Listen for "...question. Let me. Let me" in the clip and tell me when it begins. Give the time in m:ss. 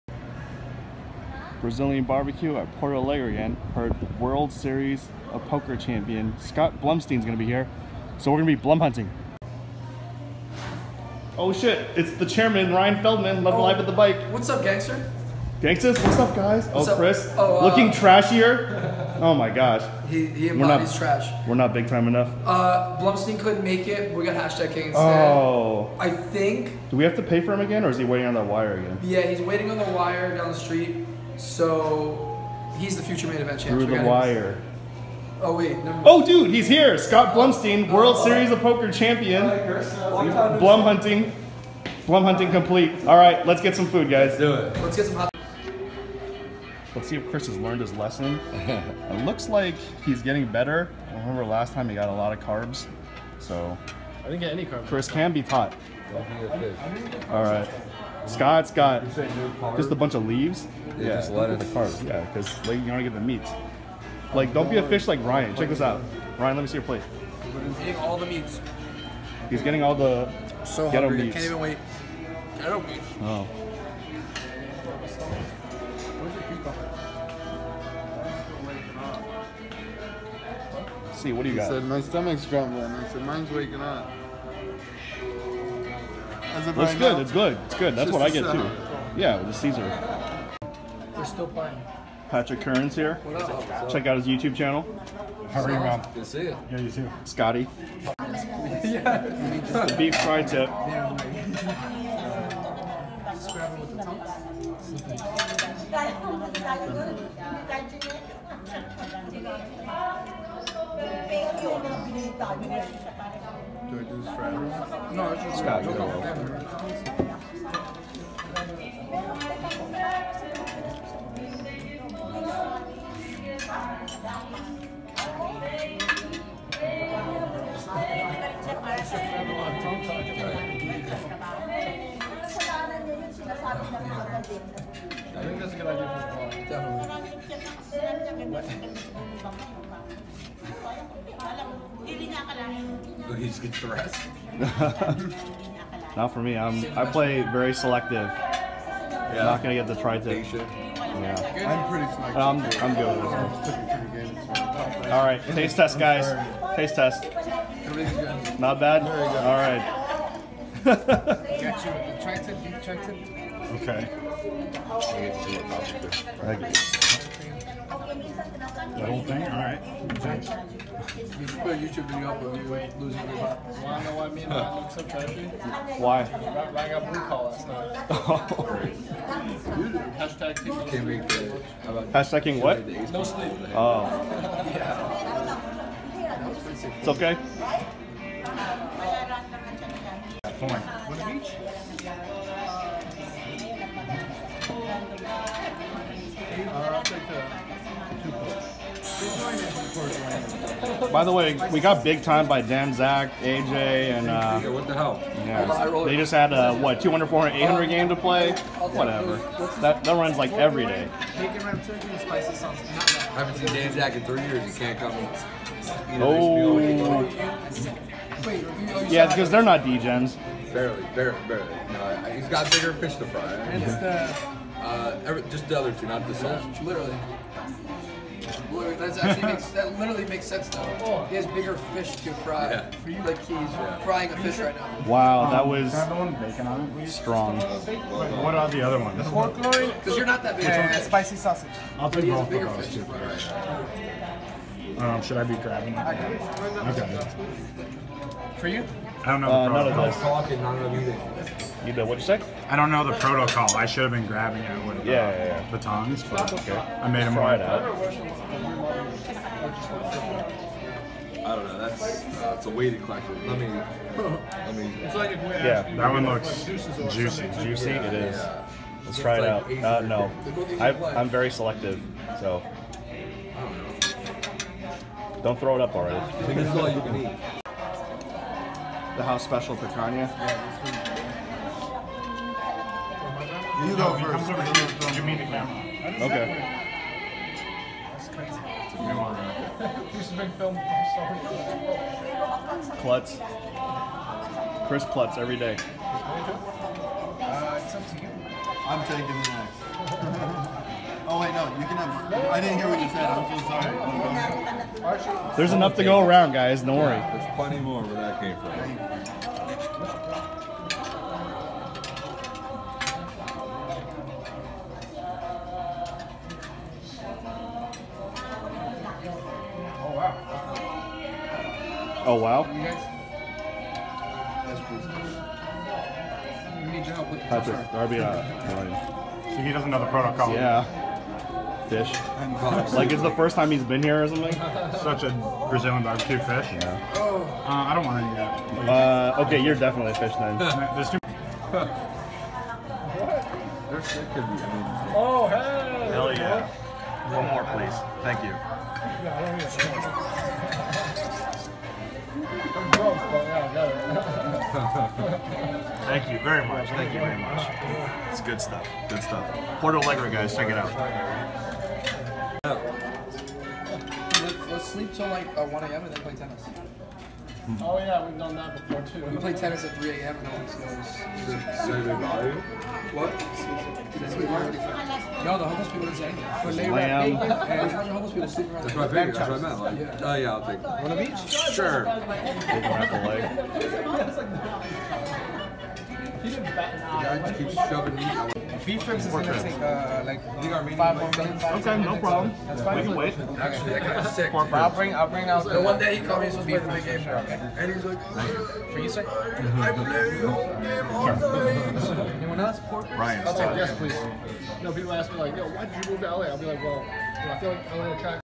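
4:23.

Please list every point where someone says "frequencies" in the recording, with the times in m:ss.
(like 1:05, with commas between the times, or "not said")
not said.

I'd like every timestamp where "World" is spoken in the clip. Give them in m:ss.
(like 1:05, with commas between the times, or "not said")
0:04, 0:37.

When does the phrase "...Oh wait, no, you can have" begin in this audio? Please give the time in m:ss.
5:01.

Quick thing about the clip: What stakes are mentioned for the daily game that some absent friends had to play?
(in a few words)
200, 400, 800.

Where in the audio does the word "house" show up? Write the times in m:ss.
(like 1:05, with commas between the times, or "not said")
4:39.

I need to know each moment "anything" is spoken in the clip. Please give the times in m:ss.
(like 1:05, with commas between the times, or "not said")
6:16.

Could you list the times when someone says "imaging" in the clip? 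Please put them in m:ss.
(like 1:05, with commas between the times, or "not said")
not said.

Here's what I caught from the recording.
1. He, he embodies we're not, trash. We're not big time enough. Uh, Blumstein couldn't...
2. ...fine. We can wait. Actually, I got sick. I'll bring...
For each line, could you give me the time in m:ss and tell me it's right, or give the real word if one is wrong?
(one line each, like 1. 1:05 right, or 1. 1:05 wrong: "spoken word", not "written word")
1. 0:20 right
2. 6:32 right.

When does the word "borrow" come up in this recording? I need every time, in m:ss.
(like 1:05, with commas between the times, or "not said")
not said.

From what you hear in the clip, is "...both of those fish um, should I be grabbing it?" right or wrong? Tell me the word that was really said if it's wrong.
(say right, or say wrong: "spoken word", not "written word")
right.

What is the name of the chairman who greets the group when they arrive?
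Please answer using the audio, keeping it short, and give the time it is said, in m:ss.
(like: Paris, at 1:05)
Ryan Feldman, at 0:12.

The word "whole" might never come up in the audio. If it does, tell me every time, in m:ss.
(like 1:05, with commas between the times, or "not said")
2:49, 6:40.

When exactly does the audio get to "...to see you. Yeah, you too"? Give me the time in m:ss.
1:36.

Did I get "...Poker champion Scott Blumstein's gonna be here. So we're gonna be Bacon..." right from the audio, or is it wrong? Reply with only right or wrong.
wrong.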